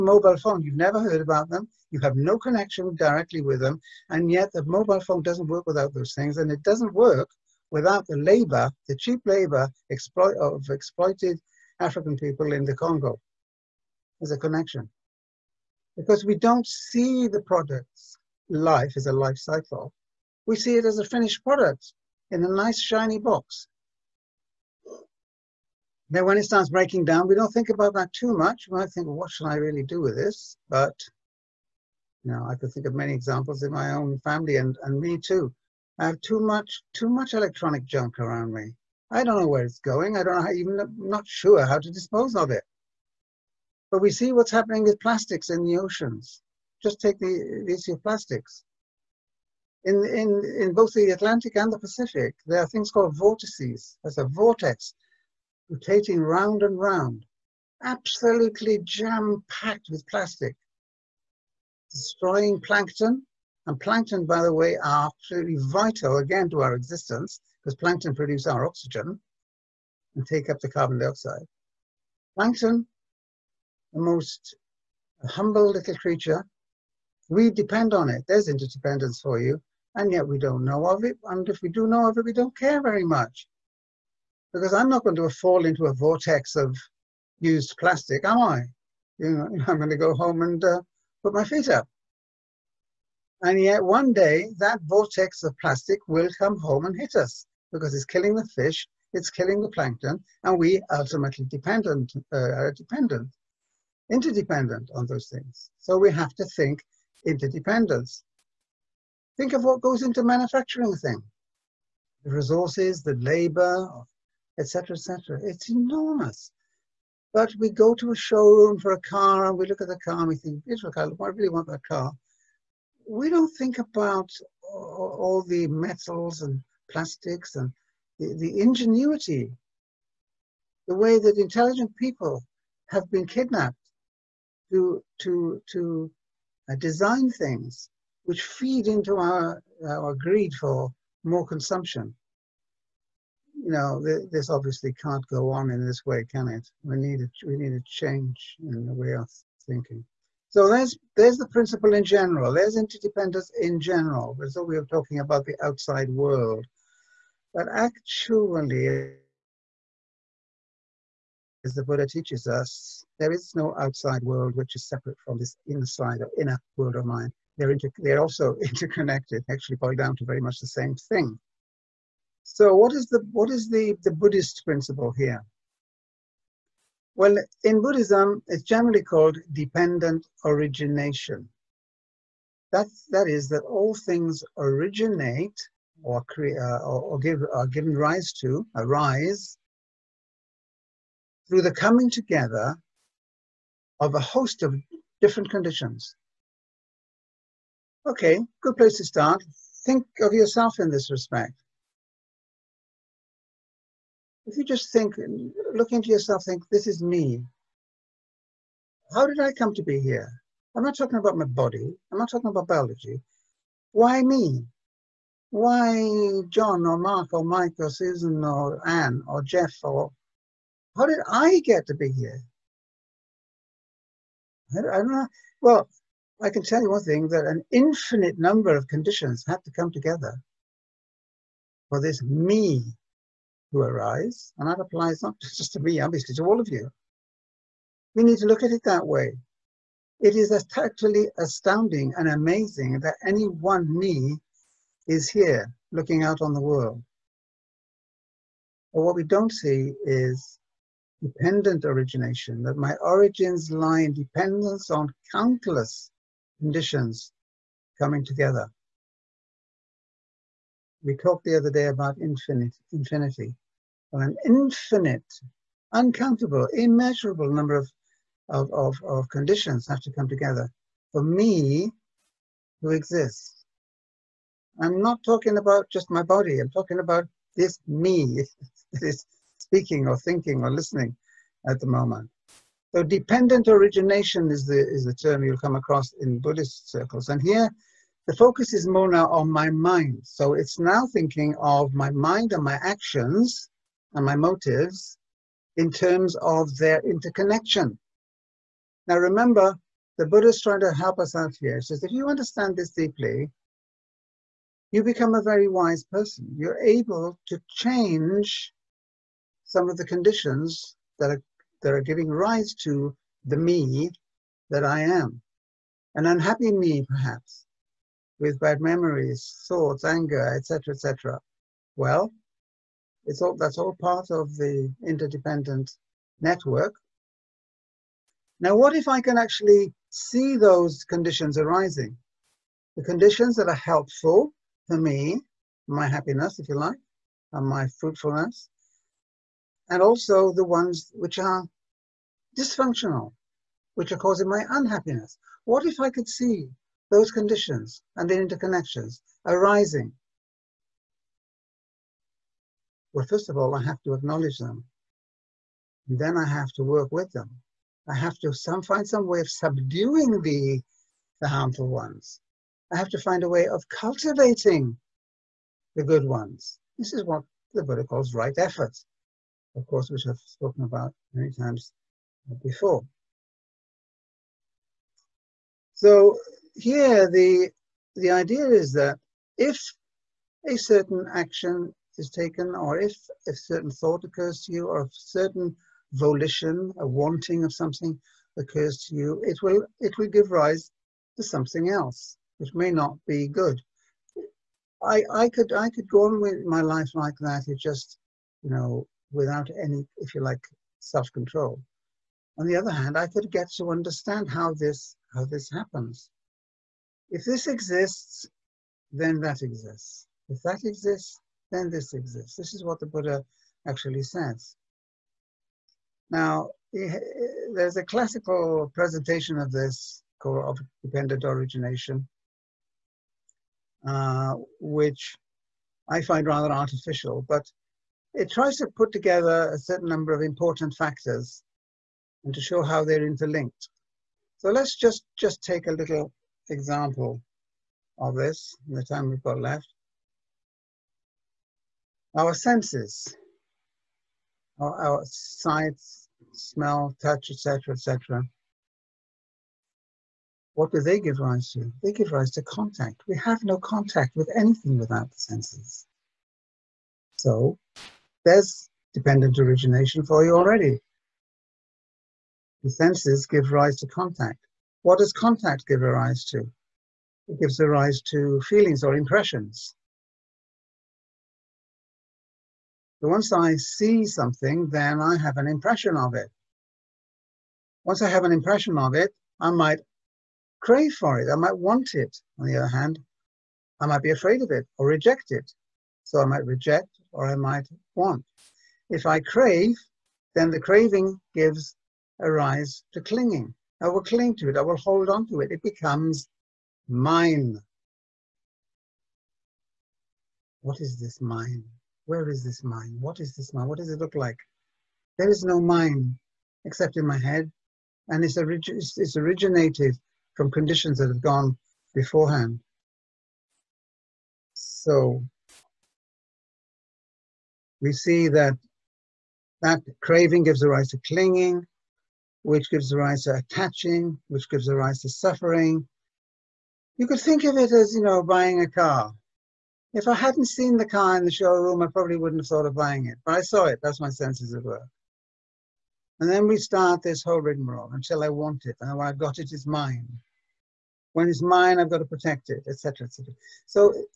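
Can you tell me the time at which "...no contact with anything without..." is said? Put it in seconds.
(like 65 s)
453 s.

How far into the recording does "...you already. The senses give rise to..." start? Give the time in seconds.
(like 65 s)
460 s.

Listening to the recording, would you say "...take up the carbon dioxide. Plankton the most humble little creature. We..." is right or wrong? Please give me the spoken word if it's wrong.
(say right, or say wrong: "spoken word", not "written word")
right.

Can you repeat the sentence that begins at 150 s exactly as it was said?
So there's, there's the principle in general.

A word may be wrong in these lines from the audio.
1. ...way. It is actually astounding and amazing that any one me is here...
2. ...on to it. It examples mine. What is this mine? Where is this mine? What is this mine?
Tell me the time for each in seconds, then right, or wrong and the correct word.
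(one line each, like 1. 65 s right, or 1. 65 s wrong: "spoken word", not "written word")
1. 239 s right
2. 495 s wrong: "becomes", not "examples".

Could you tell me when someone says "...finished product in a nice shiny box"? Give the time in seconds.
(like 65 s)
21 s.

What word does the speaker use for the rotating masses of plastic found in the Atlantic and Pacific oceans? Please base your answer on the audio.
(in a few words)
Vortices.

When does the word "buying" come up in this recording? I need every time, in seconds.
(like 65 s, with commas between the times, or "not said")
528 s, 532 s.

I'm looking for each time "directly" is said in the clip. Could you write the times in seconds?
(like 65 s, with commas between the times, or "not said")
2 s.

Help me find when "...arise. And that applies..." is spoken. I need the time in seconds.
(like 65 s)
233 s.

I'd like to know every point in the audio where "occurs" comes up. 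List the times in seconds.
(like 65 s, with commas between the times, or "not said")
384 s, 388 s.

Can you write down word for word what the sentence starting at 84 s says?
Because I'm not going to fall into a vortex of used plastic, am I?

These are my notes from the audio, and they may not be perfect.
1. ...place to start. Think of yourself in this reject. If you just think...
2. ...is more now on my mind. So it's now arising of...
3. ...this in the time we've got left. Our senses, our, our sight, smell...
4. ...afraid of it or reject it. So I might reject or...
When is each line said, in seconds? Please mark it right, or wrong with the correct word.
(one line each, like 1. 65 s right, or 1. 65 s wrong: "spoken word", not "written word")
1. 198 s wrong: "respect", not "reject"
2. 288 s wrong: "thinking", not "arising"
3. 438 s right
4. 484 s right.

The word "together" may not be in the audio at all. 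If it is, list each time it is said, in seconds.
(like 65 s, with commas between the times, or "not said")
192 s, 229 s, 258 s, 270 s, 429 s.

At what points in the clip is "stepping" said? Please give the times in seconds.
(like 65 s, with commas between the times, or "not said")
not said.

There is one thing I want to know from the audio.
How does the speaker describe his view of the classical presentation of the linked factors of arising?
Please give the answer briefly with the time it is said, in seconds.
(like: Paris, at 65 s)
Rather artificial, at 426 s.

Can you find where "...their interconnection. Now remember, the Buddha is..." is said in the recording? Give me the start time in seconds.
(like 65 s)
296 s.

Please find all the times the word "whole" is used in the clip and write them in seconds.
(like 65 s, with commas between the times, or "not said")
537 s.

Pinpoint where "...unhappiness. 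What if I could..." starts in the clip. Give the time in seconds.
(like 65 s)
344 s.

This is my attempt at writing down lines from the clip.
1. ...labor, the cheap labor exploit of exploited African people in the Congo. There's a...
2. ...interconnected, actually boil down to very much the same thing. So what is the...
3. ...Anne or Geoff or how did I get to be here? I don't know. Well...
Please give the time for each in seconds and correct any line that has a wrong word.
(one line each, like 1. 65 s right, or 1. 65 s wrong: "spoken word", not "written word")
1. 8 s right
2. 168 s right
3. 218 s right.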